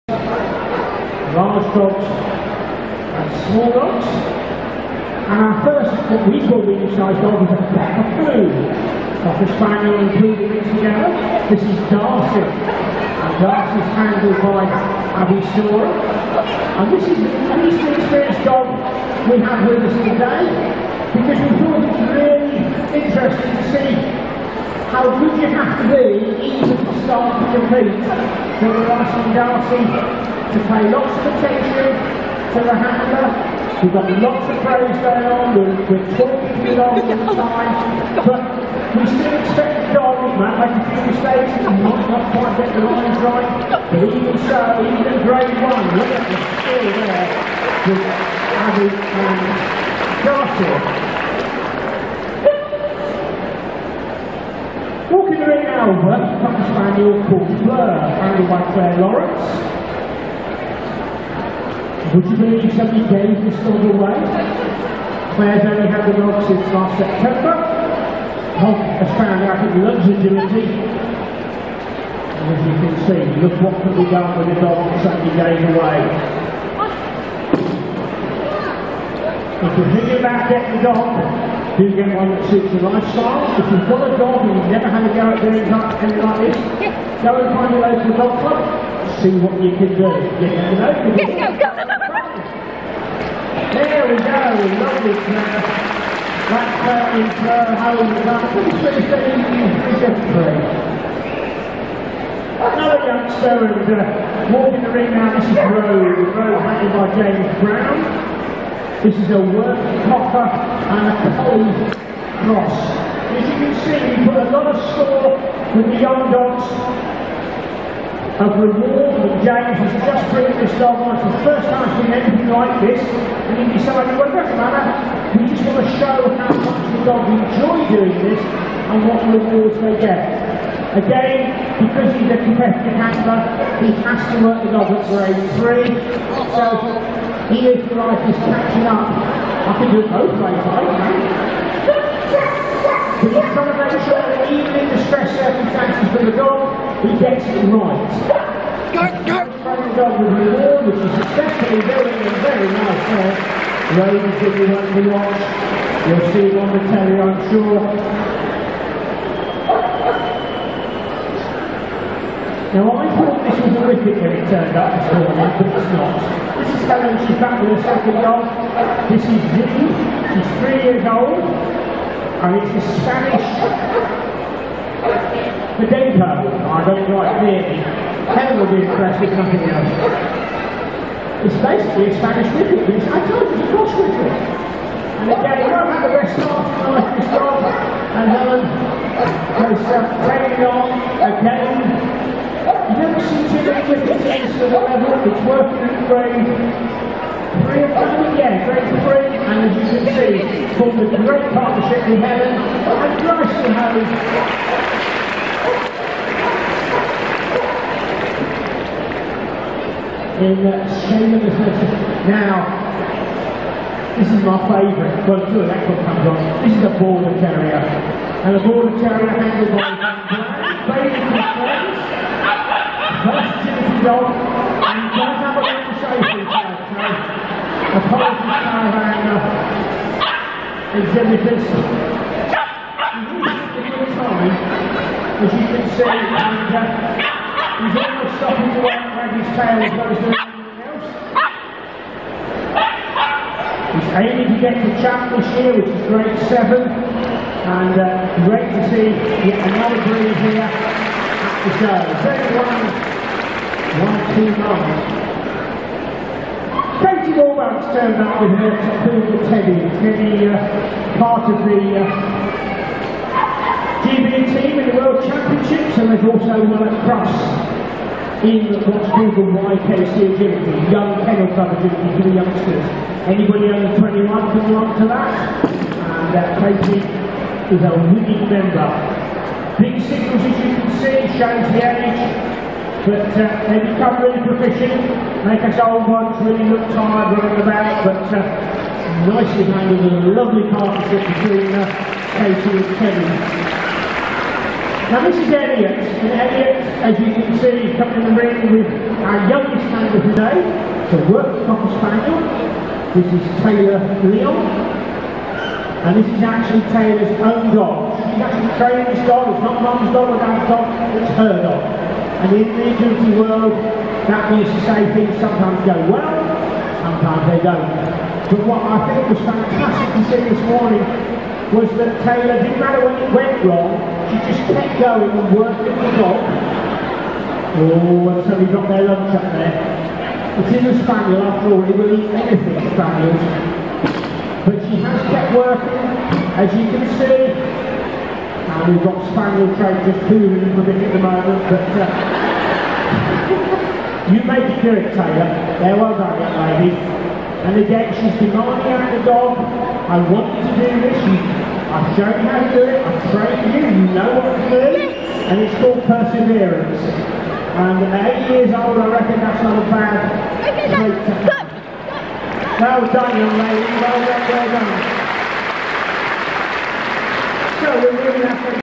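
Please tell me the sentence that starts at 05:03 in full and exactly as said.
This is Taylor Leon, and this is actually Taylor's own dog.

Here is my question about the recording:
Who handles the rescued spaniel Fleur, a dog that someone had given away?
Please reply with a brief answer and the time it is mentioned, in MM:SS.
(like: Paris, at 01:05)
Claire Lawrence, at 00:58.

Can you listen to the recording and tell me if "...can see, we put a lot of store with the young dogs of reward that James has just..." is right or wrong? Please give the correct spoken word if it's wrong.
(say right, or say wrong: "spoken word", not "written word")
right.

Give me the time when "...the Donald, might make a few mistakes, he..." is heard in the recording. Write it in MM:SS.
00:39.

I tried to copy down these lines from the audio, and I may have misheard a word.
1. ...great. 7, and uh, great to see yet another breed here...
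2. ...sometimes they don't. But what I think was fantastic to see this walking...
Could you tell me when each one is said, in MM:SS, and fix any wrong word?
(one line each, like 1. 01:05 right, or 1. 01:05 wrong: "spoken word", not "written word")
1. 04:06 right
2. 05:17 wrong: "morning", not "walking".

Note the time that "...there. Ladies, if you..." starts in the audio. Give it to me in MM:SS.
02:33.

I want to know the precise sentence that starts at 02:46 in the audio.
This is Helen, she's back with her second goal.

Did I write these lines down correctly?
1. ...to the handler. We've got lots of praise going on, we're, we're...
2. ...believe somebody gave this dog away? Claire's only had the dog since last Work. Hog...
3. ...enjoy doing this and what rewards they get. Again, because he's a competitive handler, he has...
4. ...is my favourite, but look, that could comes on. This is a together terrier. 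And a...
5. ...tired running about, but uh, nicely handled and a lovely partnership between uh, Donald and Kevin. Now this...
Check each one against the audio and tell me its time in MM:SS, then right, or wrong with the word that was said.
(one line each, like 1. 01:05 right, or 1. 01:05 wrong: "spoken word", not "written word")
1. 00:32 right
2. 01:02 wrong: "September", not "Work"
3. 02:07 right
4. 03:34 wrong: "border", not "together"
5. 04:46 wrong: "Katie", not "Donald".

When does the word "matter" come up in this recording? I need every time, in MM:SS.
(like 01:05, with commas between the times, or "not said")
02:04, 05:22.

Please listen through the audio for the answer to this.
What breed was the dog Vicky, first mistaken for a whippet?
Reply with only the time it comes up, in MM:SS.
02:53.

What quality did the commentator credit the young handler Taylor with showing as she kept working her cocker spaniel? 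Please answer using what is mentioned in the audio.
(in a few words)
Perseverance.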